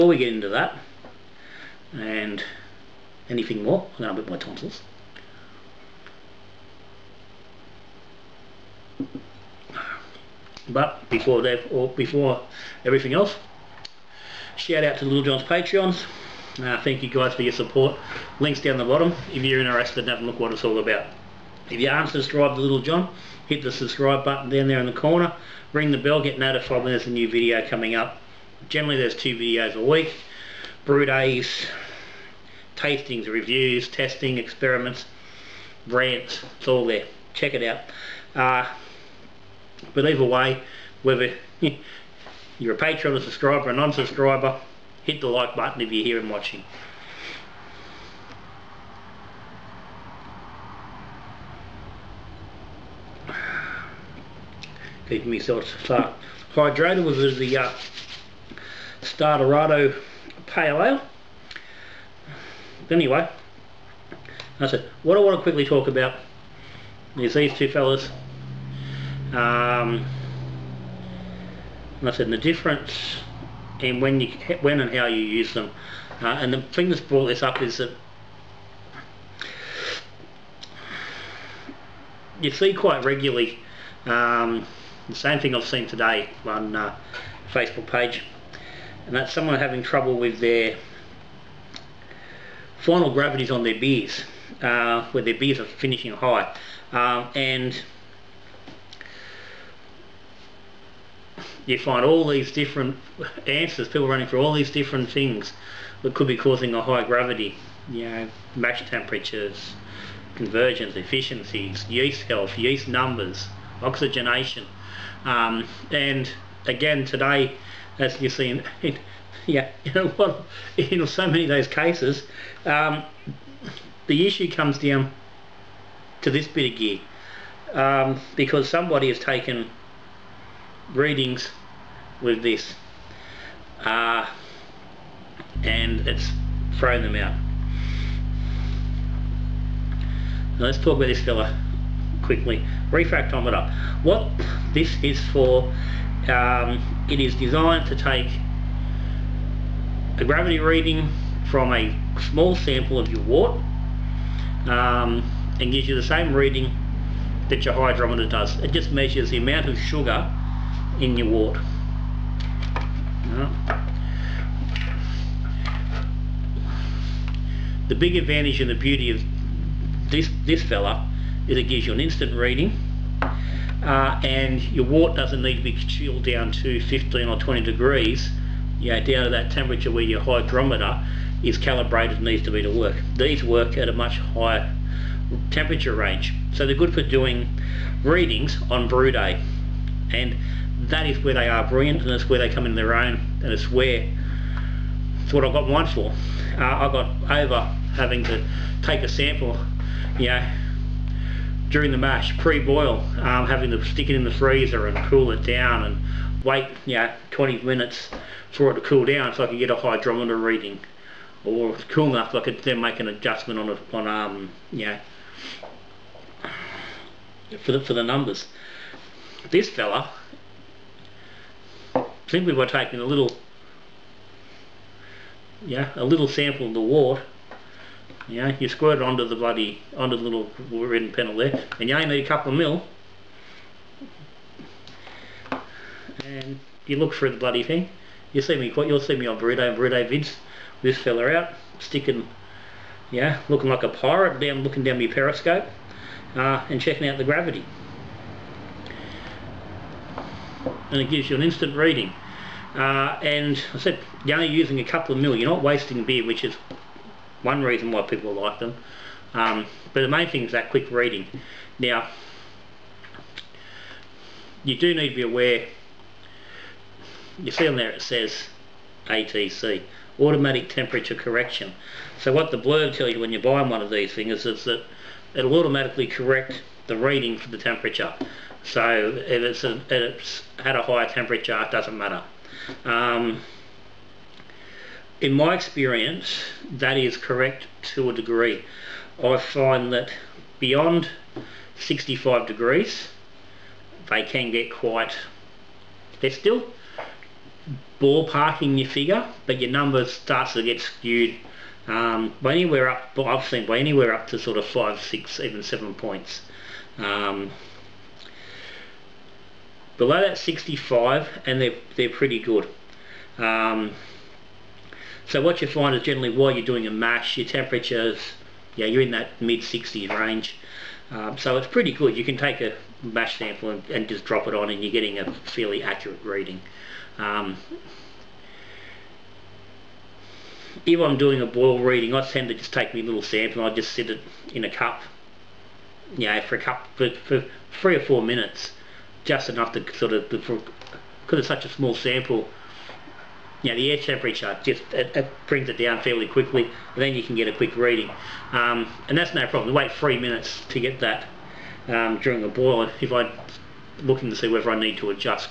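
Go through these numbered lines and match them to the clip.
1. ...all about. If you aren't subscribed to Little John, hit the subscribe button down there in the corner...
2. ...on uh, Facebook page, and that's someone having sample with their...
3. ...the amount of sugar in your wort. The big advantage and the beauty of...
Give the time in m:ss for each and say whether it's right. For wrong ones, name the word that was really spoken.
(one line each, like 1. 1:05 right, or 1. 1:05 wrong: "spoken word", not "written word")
1. 0:20 right
2. 1:26 wrong: "trouble", not "sample"
3. 2:39 right.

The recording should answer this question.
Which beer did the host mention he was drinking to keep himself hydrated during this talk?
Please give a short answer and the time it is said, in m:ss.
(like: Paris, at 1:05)
Starderado Pale Ale, at 0:59.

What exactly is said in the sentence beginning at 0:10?
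But before that, or before everything else, shout out to Little John's Patreons.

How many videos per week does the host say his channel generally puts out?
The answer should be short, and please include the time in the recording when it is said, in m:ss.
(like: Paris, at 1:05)
2, at 0:29.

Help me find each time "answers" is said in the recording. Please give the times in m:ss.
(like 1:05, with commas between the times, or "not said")
1:43.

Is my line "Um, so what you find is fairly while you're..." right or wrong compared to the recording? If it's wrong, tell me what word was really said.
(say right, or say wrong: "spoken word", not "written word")
wrong: "generally", not "fairly".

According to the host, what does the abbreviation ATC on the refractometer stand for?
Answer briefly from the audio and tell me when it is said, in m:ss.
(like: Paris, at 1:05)
Automatic Temperature Correction, at 4:30.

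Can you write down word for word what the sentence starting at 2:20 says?
Now let's talk about this fella quickly refractometer.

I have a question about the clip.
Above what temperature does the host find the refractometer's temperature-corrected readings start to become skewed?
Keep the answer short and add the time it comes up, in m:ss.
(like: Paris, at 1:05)
65 degrees, at 4:51.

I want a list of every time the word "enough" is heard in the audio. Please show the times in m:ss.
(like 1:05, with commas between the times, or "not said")
3:32, 5:39.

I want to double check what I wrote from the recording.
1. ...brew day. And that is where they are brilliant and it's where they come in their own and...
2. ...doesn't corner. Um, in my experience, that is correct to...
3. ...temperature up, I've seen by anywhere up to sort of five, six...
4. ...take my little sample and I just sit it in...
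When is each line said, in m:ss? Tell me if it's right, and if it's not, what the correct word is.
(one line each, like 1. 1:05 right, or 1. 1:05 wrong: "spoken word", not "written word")
1. 3:08 right
2. 4:41 wrong: "matter", not "corner"
3. 5:02 wrong: "anywhere", not "temperature"
4. 5:32 right.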